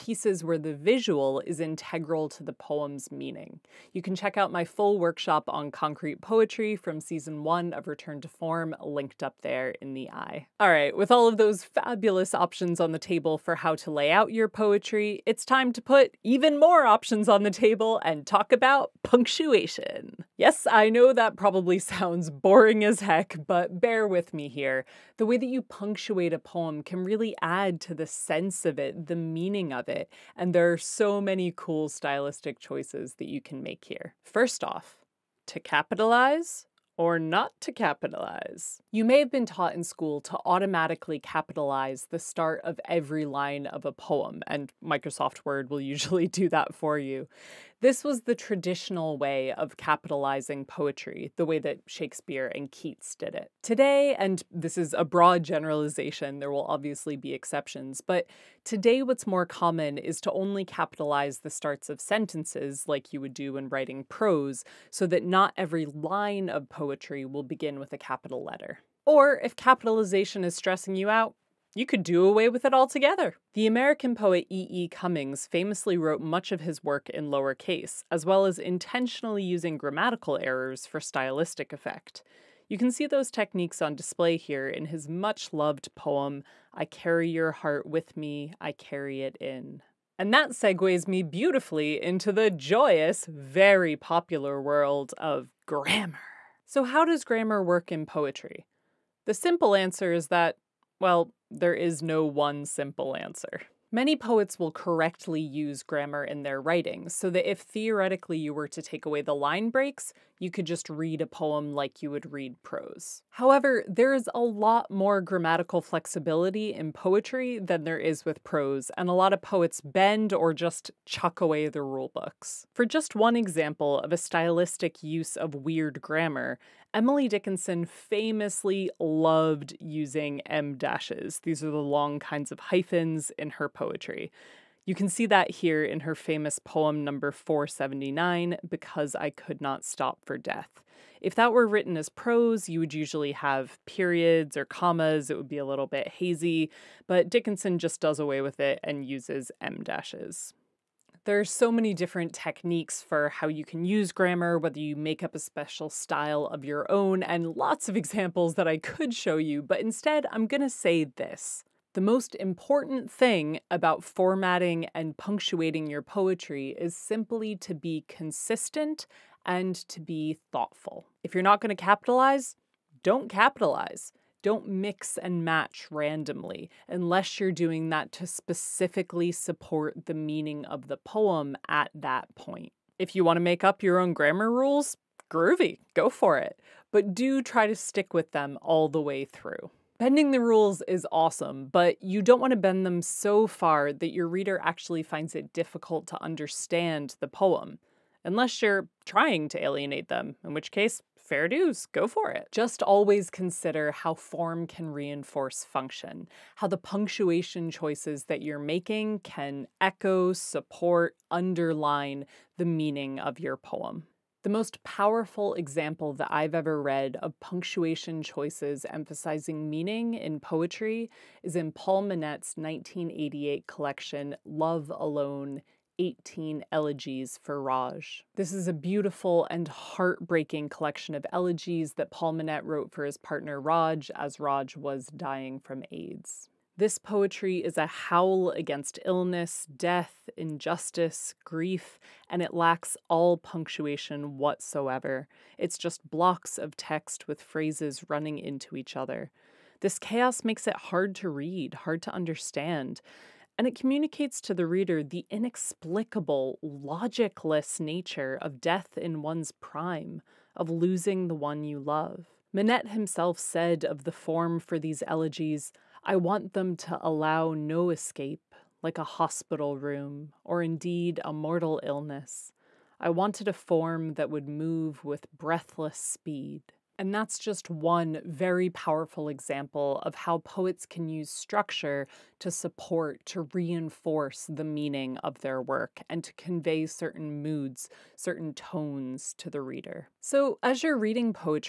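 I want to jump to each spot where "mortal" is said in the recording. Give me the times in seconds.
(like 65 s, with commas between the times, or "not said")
271 s.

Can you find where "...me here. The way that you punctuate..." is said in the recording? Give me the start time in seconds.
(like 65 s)
24 s.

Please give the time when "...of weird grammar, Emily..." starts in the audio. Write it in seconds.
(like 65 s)
125 s.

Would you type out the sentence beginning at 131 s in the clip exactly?
These are the long kinds of hyphens in her poetry.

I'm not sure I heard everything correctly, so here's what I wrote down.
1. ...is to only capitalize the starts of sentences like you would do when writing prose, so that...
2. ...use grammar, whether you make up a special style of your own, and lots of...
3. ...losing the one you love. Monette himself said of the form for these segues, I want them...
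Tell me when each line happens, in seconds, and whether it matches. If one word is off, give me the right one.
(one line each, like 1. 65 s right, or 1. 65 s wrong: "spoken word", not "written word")
1. 59 s right
2. 153 s right
3. 260 s wrong: "elegies", not "segues".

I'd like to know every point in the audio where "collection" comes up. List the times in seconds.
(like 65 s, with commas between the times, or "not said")
223 s, 230 s.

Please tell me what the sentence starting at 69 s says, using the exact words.
Or if capitalization is stressing you out, you could do away with it altogether.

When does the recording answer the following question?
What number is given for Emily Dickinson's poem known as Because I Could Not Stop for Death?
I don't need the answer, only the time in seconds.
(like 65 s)
137 s.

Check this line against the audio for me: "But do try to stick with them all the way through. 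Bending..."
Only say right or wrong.
right.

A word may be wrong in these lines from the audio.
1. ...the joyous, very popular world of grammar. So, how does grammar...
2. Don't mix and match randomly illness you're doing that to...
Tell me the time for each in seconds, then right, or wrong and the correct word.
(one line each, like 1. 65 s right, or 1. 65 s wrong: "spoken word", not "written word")
1. 92 s right
2. 174 s wrong: "unless", not "illness".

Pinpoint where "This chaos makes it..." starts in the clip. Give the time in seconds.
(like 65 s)
249 s.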